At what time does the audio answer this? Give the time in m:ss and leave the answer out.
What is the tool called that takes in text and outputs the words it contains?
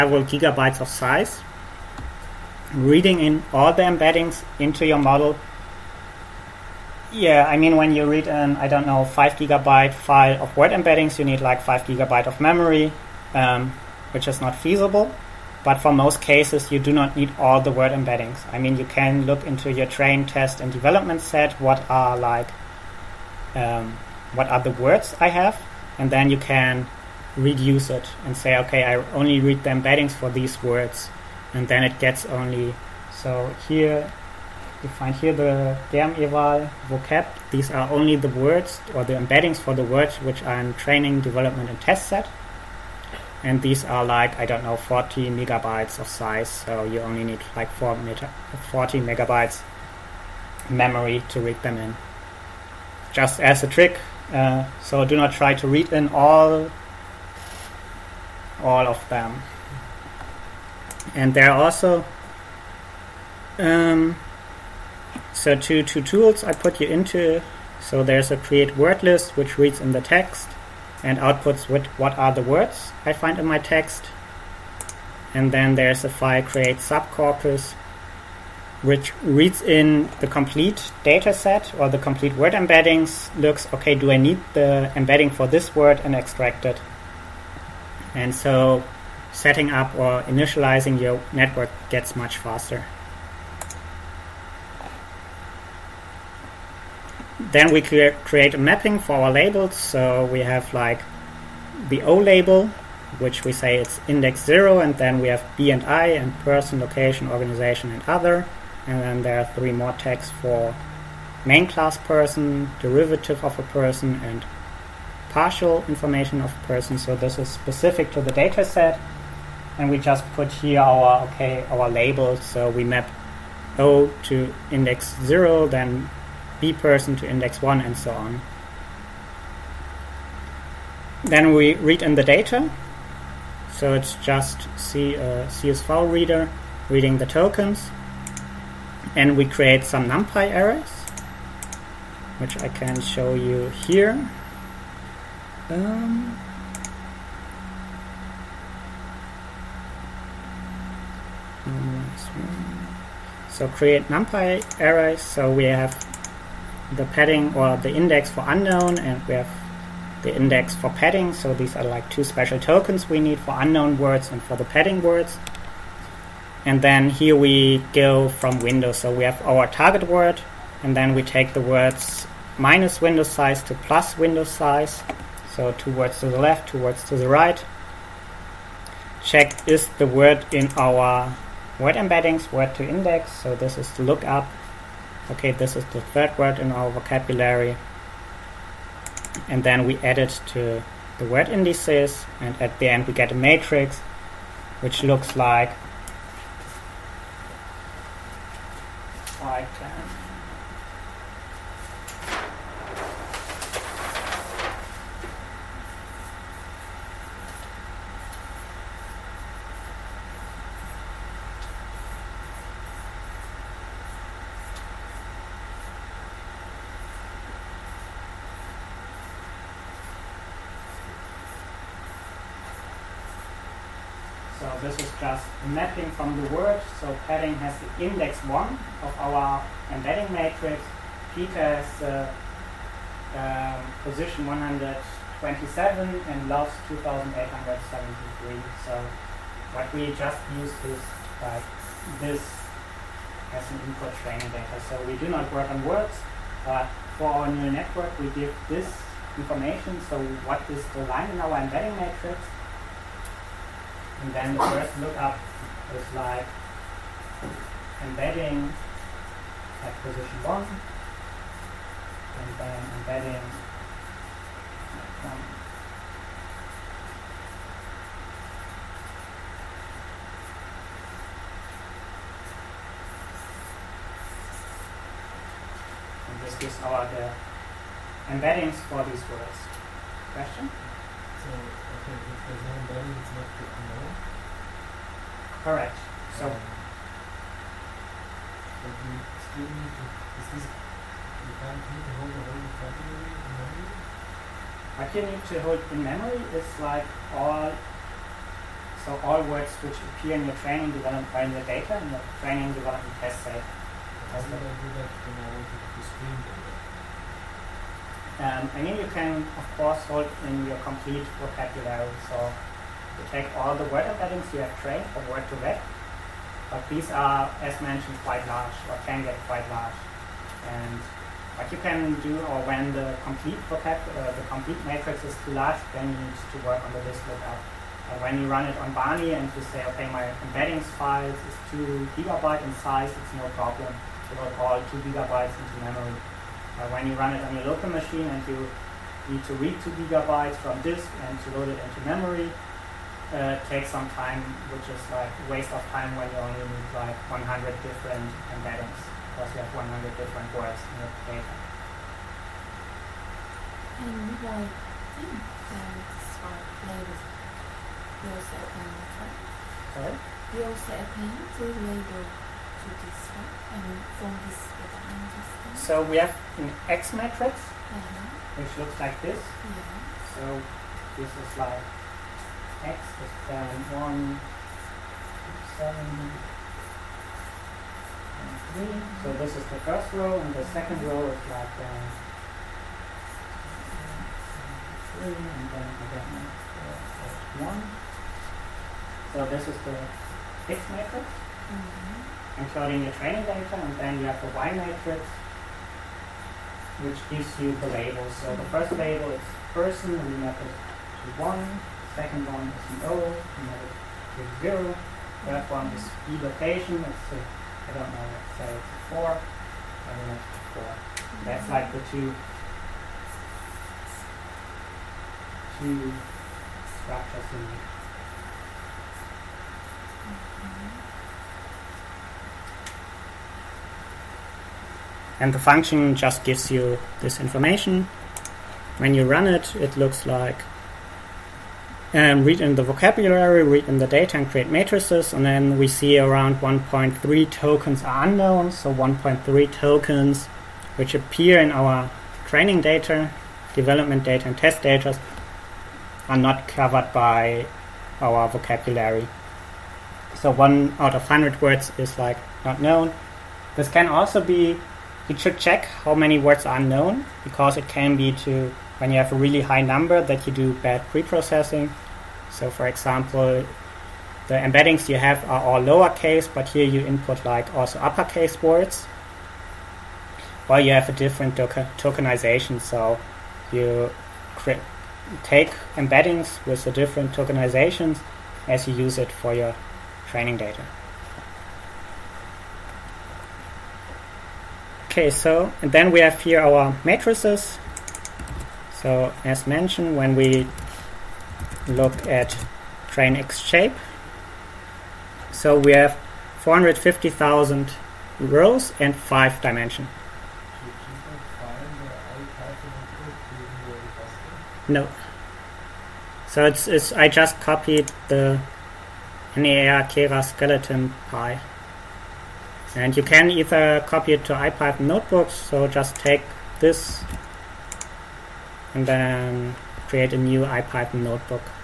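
1:08.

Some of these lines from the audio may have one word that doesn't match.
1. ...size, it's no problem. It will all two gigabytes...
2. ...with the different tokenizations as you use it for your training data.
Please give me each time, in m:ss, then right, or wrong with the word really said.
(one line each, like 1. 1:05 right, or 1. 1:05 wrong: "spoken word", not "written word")
1. 5:32 right
2. 7:56 right.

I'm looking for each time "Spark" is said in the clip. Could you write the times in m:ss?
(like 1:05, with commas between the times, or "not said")
5:56.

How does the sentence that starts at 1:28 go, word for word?
And so setting up or initializing your network gets much faster.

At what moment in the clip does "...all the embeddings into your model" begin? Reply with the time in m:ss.
0:03.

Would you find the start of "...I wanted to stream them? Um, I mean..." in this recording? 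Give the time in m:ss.
5:05.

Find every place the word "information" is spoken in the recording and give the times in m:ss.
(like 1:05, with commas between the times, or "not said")
1:55, 4:09, 7:07.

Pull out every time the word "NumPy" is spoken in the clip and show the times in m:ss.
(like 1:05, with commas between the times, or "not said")
2:20, 2:34.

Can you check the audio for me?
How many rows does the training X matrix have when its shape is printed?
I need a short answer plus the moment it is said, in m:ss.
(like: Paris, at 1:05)
450,000, at 8:16.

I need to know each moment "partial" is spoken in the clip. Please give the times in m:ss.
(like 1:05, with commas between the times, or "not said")
1:55.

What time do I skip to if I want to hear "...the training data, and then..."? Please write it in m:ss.
6:33.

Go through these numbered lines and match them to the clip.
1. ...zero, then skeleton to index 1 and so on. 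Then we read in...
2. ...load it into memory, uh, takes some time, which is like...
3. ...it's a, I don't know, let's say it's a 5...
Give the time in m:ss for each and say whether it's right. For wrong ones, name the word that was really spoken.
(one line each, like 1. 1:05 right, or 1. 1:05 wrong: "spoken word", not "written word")
1. 2:05 wrong: "person", not "skeleton"
2. 5:41 right
3. 6:47 wrong: "4", not "5".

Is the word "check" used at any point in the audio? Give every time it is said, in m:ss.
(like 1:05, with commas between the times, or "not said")
2:59, 7:35.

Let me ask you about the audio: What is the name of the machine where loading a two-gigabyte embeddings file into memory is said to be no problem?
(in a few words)
Barney.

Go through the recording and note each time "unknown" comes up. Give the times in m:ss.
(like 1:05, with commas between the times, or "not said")
2:38, 2:43, 4:43, 7:18.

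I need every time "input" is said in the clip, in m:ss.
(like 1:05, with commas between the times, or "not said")
4:03, 7:47.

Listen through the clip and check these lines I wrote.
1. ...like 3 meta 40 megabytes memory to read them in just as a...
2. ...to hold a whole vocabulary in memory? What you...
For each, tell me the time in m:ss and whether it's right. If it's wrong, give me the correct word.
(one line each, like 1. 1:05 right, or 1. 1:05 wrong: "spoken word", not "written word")
1. 0:47 wrong: "4", not "3"
2. 4:52 right.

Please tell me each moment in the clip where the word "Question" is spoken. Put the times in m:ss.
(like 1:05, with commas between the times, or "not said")
4:40.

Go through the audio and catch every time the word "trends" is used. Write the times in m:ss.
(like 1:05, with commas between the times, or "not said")
not said.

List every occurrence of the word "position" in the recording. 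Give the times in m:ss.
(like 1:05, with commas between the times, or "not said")
3:54, 4:20.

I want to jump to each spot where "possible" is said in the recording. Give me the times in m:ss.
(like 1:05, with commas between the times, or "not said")
not said.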